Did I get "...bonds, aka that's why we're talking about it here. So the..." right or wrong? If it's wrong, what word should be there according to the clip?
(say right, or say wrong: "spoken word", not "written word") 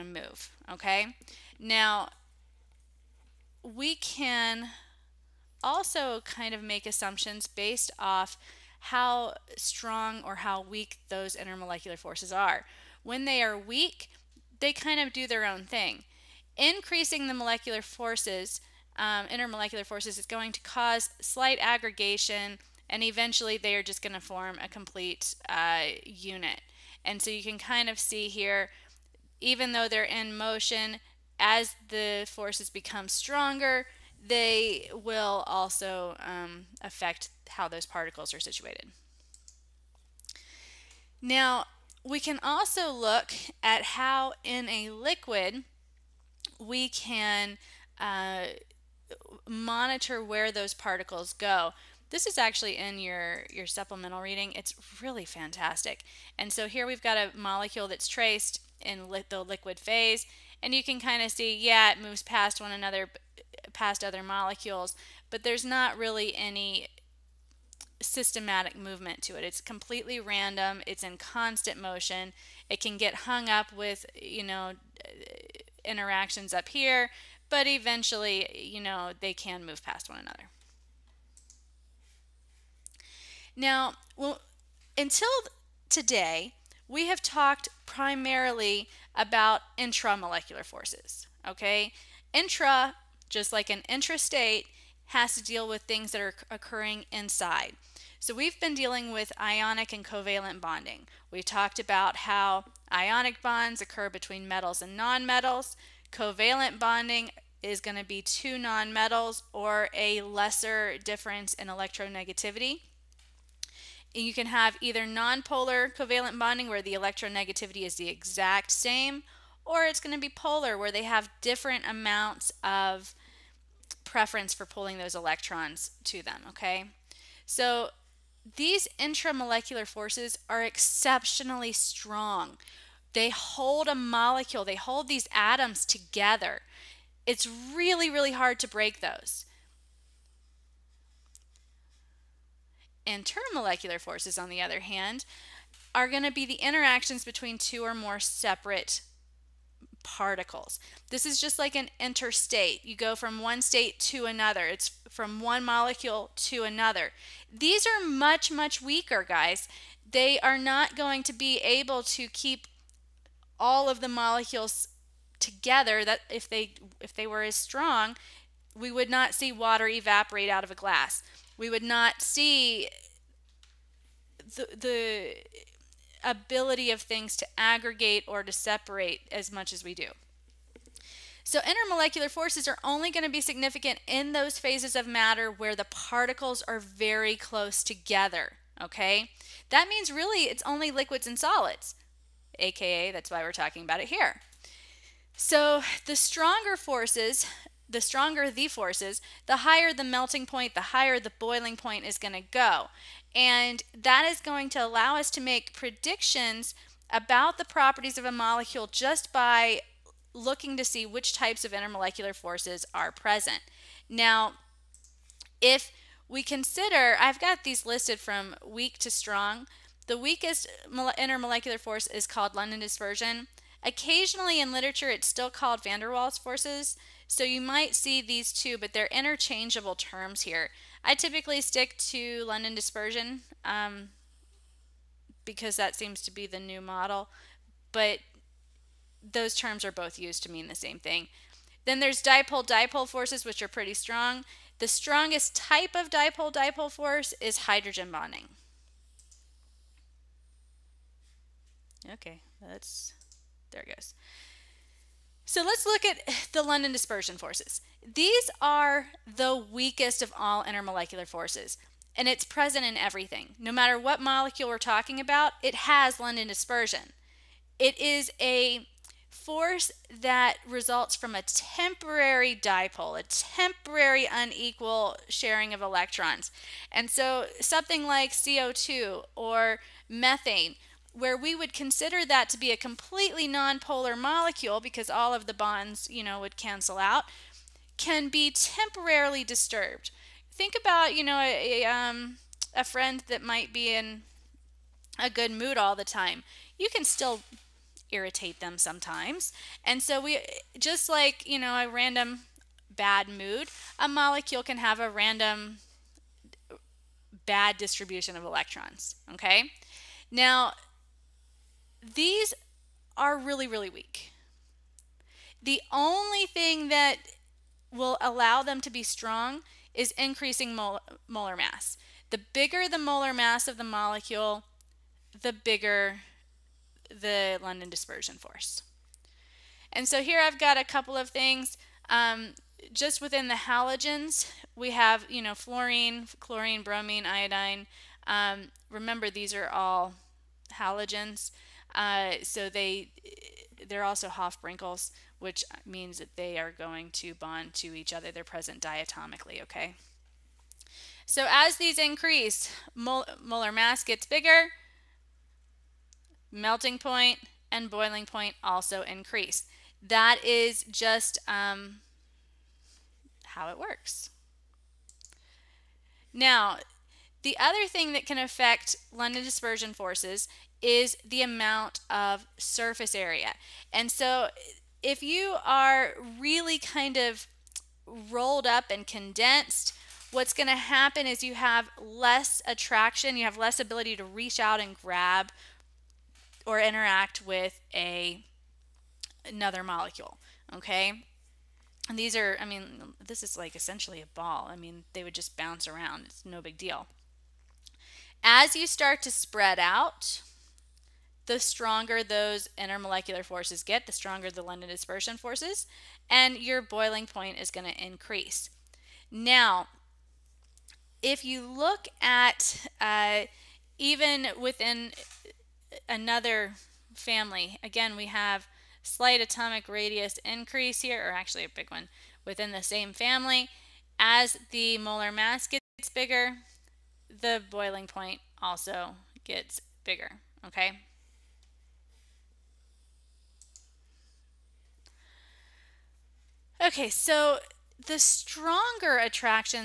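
wrong: "solids", not "bonds".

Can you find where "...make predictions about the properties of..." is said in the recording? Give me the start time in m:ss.
3:25.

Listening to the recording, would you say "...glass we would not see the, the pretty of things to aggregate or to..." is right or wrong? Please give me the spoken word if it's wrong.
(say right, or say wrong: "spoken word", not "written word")
wrong: "ability", not "pretty".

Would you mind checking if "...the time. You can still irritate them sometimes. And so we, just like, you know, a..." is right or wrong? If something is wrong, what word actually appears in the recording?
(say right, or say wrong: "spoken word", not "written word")
right.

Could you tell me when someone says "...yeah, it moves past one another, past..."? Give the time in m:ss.
1:01.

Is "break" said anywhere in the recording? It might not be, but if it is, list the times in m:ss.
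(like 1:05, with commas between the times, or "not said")
2:18.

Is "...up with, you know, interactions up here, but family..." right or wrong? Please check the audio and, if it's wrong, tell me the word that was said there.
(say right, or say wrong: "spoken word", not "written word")
wrong: "eventually", not "family".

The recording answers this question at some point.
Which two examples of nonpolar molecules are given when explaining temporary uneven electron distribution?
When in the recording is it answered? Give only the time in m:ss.
4:38.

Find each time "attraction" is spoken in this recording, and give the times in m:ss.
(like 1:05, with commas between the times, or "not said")
6:22, 7:19.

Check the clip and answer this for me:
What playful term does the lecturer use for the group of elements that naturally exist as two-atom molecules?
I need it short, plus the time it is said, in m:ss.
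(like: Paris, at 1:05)
Hofbrinkles, at 5:44.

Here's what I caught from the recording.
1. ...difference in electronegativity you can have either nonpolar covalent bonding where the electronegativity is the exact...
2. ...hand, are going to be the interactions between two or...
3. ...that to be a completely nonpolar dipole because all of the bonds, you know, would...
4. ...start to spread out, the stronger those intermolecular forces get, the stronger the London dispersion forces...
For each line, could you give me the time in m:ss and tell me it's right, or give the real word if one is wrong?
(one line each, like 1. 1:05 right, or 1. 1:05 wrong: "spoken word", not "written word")
1. 1:51 right
2. 2:24 right
3. 4:42 wrong: "molecule", not "dipole"
4. 6:38 right.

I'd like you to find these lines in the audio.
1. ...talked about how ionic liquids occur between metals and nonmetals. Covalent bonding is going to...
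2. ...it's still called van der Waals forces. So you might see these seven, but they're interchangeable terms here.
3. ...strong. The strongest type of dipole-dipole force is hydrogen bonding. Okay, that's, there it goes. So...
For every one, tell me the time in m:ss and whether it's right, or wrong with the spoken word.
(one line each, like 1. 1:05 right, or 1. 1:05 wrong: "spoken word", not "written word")
1. 1:41 wrong: "bonds", not "liquids"
2. 3:45 wrong: "two", not "seven"
3. 4:03 right.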